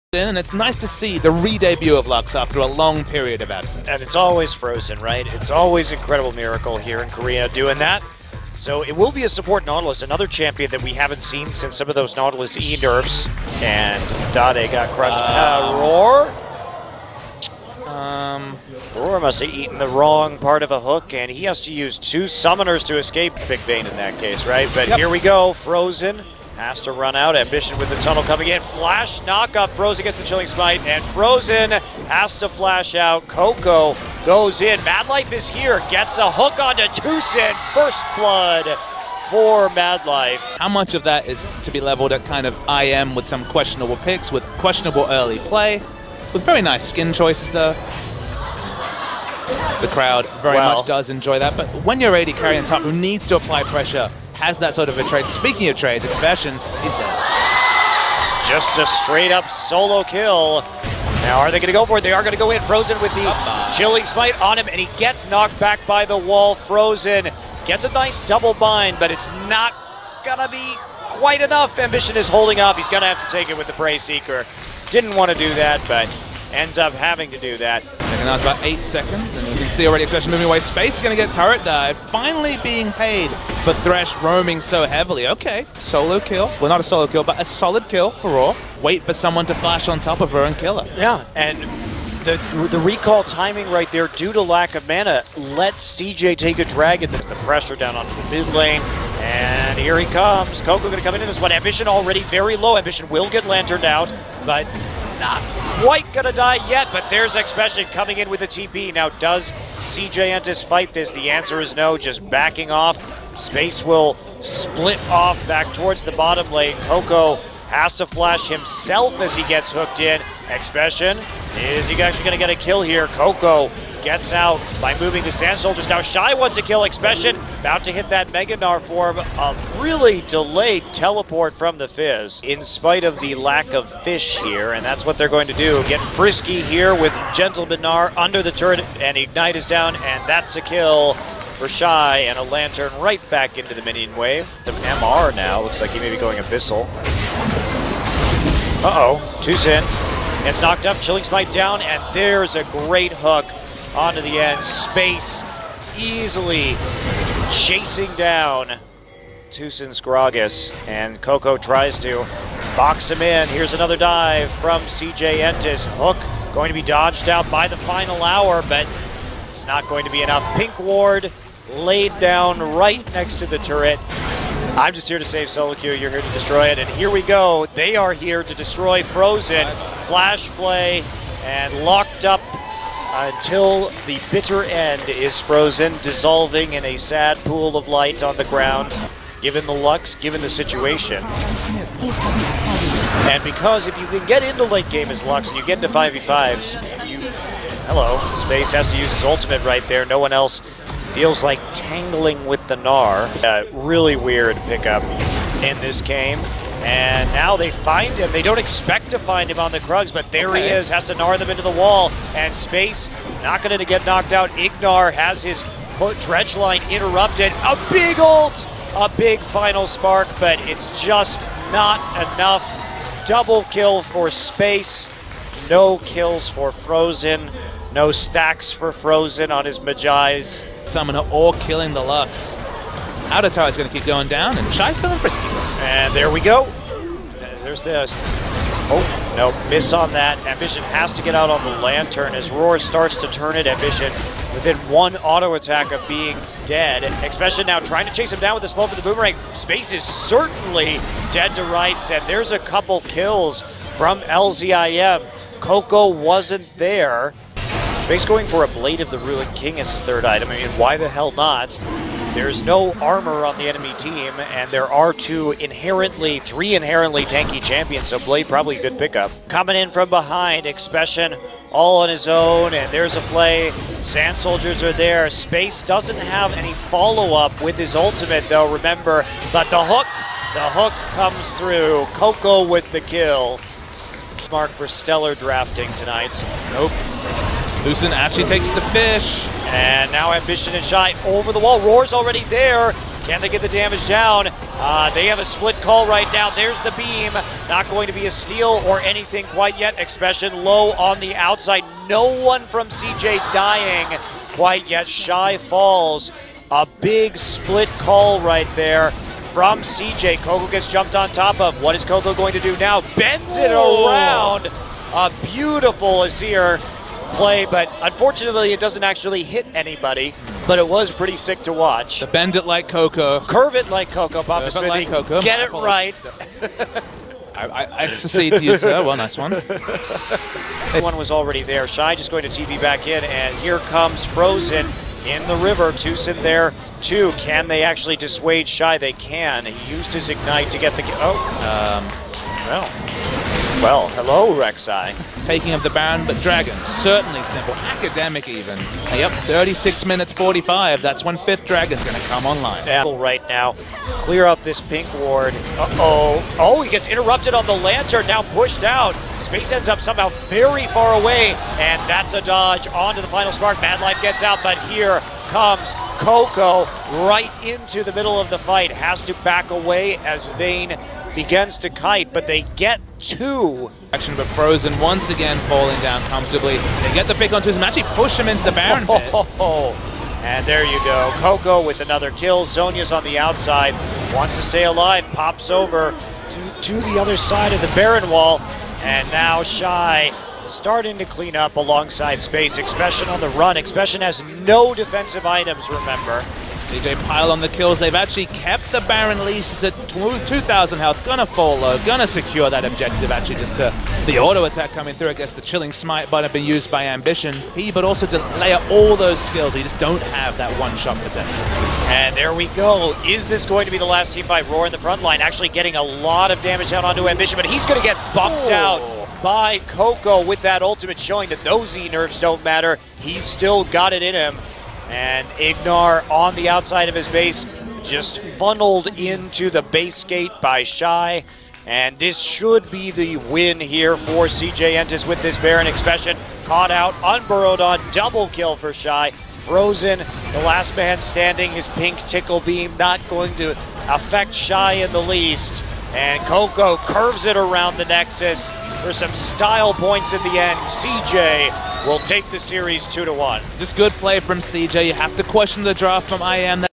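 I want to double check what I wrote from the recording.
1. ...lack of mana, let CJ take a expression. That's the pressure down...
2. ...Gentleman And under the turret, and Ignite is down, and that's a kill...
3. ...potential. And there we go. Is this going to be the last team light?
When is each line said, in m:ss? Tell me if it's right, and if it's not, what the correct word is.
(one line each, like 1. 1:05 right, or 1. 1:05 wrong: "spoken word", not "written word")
1. 1:34 wrong: "dragon", not "expression"
2. 2:17 wrong: "Gnar", not "And"
3. 6:51 wrong: "fight", not "light".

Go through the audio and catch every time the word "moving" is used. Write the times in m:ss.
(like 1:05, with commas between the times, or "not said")
1:20, 2:04.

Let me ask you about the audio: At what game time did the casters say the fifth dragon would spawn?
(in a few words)
36:45.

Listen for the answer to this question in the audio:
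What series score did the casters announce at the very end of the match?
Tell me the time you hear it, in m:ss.
7:33.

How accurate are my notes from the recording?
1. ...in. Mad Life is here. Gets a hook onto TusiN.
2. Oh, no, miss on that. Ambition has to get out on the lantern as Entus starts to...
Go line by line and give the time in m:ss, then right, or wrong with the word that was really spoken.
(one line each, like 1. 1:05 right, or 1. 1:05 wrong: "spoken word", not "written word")
1. 0:34 right
2. 3:58 wrong: "Roar", not "Entus".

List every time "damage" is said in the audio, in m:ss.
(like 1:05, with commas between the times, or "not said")
4:53, 6:56.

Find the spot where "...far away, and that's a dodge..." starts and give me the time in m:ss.
6:00.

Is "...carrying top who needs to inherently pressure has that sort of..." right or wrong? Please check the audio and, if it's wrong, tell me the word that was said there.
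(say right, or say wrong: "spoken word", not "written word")
wrong: "apply", not "inherently".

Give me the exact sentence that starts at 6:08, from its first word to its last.
Has to back away as Vayne begins to kite, but they get two.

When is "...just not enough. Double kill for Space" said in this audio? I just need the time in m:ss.
3:41.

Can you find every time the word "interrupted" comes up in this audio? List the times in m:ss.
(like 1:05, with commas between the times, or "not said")
3:36, 5:57.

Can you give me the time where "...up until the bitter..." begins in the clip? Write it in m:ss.
3:02.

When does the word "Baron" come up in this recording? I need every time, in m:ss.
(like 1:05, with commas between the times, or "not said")
5:45, 6:18, 6:27, 6:39, 7:15.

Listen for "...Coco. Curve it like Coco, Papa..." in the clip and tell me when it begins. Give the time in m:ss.
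5:22.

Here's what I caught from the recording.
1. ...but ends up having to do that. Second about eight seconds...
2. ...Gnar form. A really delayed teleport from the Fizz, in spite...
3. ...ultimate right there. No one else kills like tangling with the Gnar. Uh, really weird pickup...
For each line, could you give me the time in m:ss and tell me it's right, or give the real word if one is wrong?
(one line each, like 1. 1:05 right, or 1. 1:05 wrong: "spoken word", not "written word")
1. 1:15 right
2. 2:08 right
3. 3:19 wrong: "feels", not "kills".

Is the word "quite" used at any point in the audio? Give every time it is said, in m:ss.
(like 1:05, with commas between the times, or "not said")
1:11, 1:45, 4:59, 5:04.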